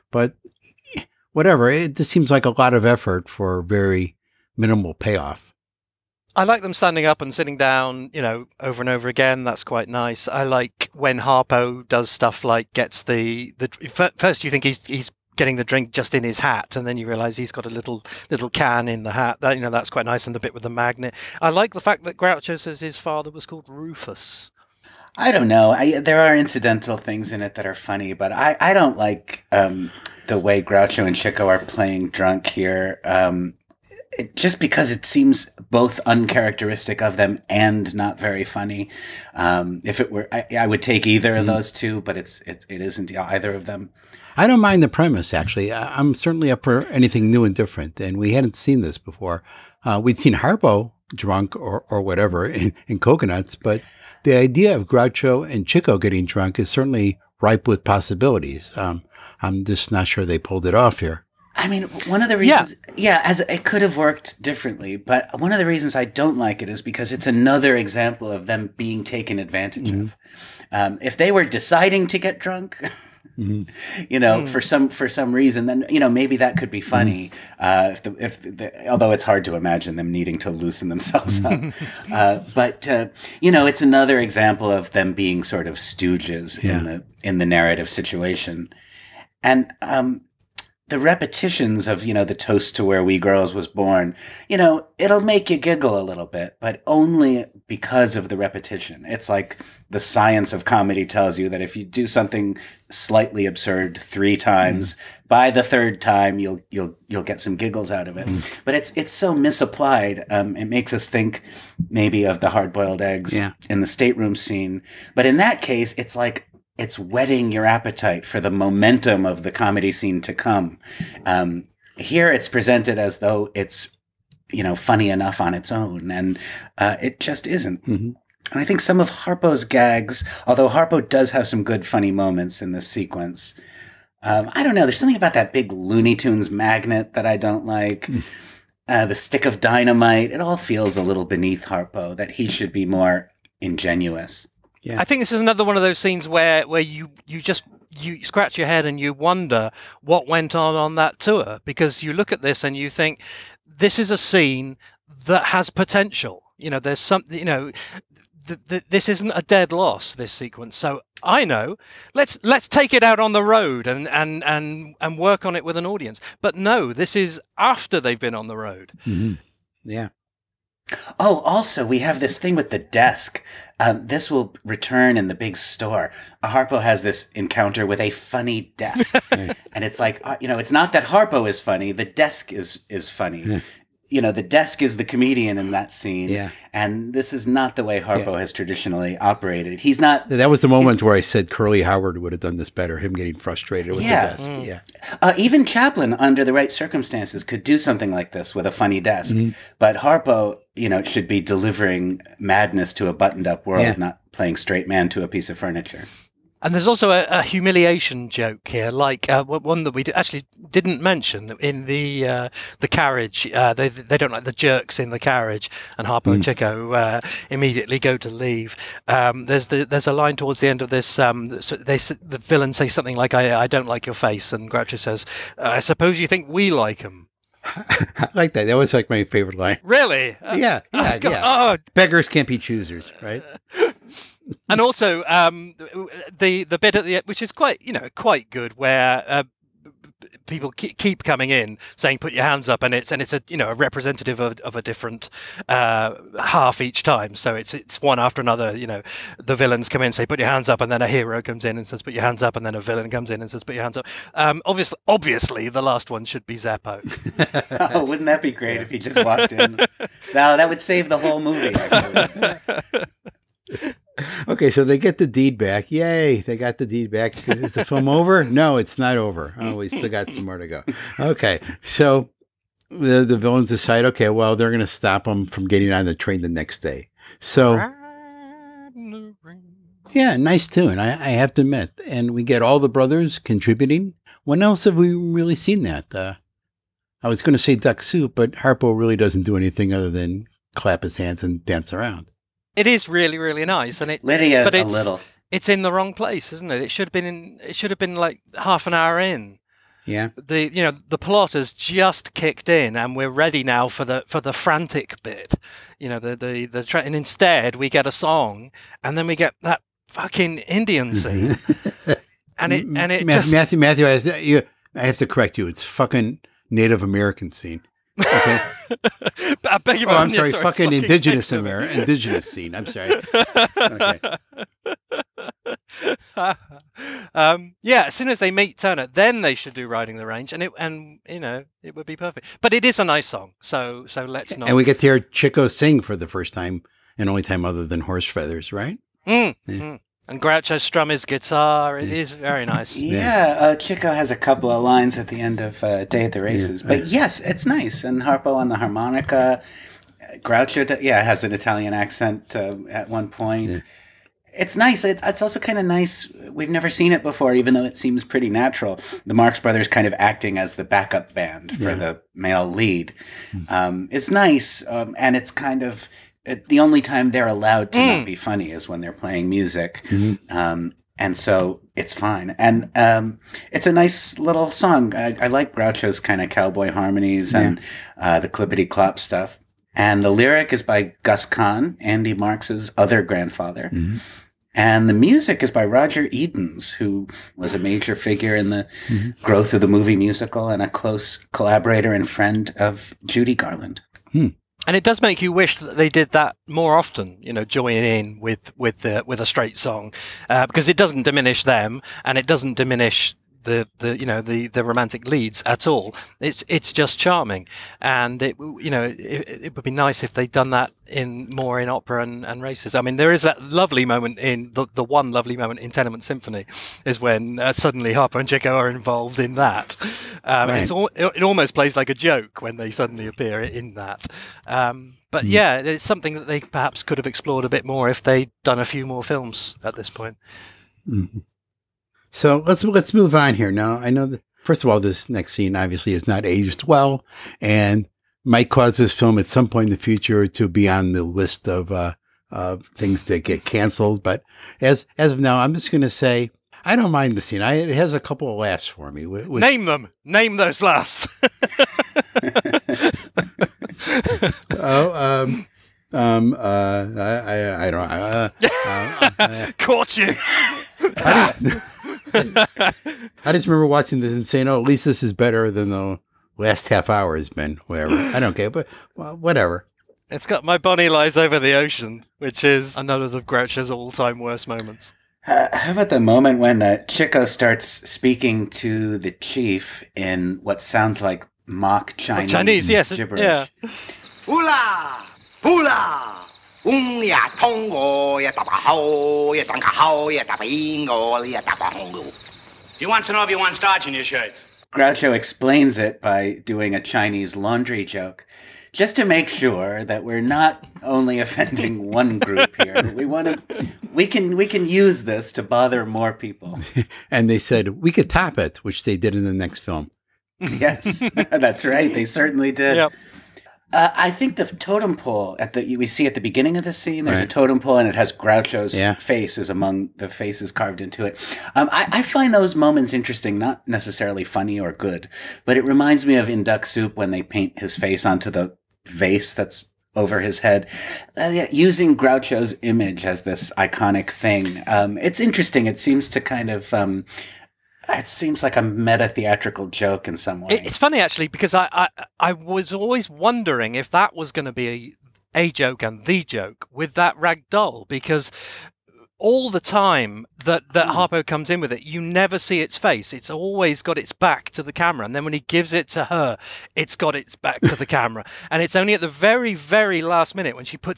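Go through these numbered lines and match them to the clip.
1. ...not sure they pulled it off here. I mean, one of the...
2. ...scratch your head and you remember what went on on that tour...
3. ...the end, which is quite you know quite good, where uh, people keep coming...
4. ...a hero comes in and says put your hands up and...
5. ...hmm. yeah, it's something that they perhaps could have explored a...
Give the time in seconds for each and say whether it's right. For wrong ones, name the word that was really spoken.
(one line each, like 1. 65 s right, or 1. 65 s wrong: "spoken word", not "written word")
1. 59 s right
2. 148 s wrong: "wonder", not "remember"
3. 237 s right
4. 251 s right
5. 425 s right.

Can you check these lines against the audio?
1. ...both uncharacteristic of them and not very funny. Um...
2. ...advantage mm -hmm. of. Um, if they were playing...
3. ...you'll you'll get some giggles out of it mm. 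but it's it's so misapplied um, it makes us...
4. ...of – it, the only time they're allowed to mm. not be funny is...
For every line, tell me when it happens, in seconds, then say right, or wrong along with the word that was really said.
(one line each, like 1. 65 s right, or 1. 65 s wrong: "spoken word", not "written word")
1. 35 s right
2. 69 s wrong: "deciding", not "playing"
3. 106 s right
4. 365 s right.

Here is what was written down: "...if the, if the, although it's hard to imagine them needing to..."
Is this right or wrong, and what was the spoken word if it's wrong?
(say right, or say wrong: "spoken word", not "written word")
right.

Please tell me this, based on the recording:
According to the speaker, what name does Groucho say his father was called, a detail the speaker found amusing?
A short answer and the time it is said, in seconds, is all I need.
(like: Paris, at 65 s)
Rufus, at 23 s.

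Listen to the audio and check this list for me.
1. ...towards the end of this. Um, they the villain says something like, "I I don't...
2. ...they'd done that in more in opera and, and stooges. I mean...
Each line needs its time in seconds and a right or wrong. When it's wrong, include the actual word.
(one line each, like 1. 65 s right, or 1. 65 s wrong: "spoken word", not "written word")
1. 220 s right
2. 410 s wrong: "races", not "stooges".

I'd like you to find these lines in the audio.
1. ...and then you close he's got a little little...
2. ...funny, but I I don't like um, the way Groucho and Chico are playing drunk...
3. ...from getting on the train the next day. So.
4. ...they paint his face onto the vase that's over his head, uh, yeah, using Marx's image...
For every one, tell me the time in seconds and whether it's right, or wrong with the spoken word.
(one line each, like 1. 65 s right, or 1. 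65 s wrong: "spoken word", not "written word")
1. 16 s wrong: "realise", not "close"
2. 27 s right
3. 275 s right
4. 527 s wrong: "Groucho", not "Marx".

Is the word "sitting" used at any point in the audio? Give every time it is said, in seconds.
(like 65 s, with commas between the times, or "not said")
7 s.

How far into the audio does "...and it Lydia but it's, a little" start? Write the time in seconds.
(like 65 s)
294 s.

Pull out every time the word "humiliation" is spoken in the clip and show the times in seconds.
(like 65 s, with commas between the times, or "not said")
207 s.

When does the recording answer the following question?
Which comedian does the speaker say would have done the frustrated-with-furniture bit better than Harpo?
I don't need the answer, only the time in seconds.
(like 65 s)
191 s.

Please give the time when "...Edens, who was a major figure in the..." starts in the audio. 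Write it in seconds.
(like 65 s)
386 s.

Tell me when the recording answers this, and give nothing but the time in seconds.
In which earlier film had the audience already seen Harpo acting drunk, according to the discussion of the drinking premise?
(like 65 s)
52 s.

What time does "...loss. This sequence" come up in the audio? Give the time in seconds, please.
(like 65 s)
159 s.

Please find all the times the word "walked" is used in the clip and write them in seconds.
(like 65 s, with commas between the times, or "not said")
259 s.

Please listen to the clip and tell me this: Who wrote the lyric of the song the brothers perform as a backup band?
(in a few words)
Gus Kahn.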